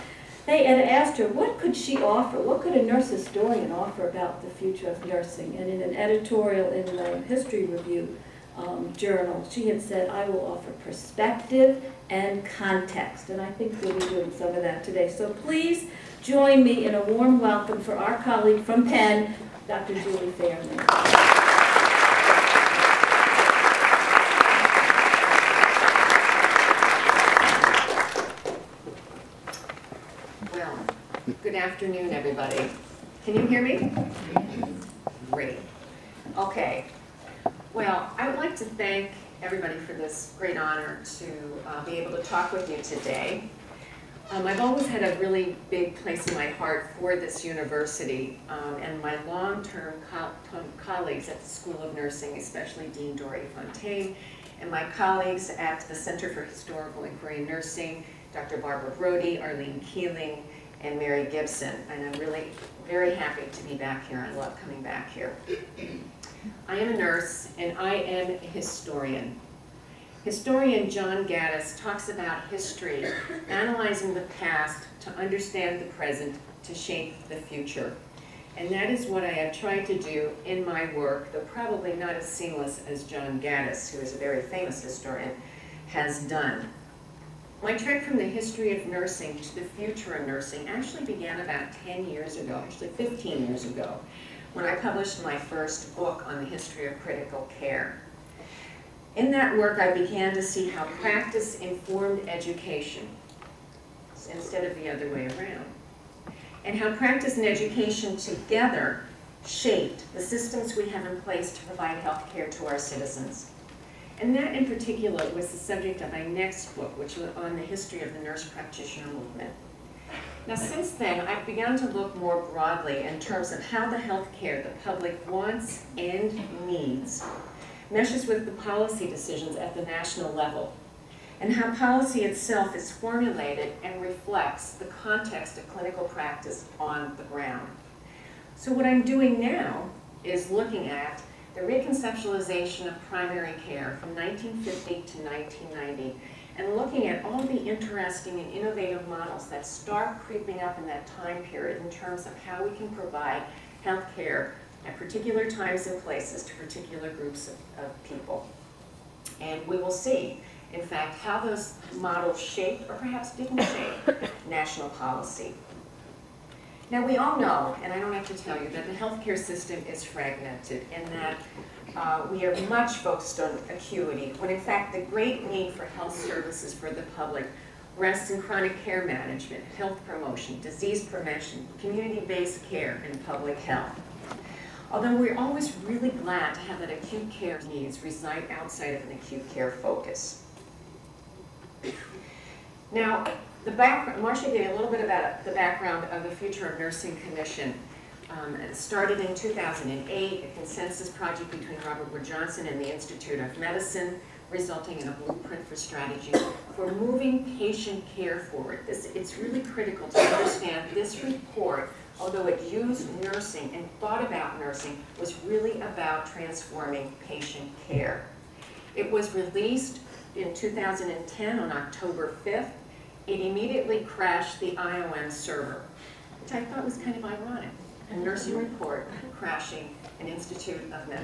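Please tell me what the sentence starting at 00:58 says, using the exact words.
Barbara Brodie, Arlene Keeling, and Mary Gibson, and I'm really very happy to be back here.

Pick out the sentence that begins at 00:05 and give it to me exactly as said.
And in an editorial in the History Review um, journal, she had said, I will offer perspective and context.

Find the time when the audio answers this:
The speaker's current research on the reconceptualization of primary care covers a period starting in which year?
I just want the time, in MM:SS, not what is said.
02:24.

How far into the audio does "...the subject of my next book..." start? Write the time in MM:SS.
01:55.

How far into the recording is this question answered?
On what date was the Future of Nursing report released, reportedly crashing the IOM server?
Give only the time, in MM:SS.
03:41.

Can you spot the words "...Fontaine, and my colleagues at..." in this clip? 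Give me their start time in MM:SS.
00:53.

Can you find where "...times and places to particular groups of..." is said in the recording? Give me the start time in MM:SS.
02:35.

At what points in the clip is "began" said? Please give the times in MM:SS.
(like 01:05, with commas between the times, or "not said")
01:31, 01:39.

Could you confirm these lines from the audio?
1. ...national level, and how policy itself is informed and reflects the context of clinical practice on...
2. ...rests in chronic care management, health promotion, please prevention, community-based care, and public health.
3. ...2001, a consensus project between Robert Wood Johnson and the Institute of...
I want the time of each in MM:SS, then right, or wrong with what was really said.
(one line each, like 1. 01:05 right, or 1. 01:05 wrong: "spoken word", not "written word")
1. 02:09 wrong: "formulated", not "informed"
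2. 02:57 wrong: "disease", not "please"
3. 03:19 wrong: "2008", not "2001".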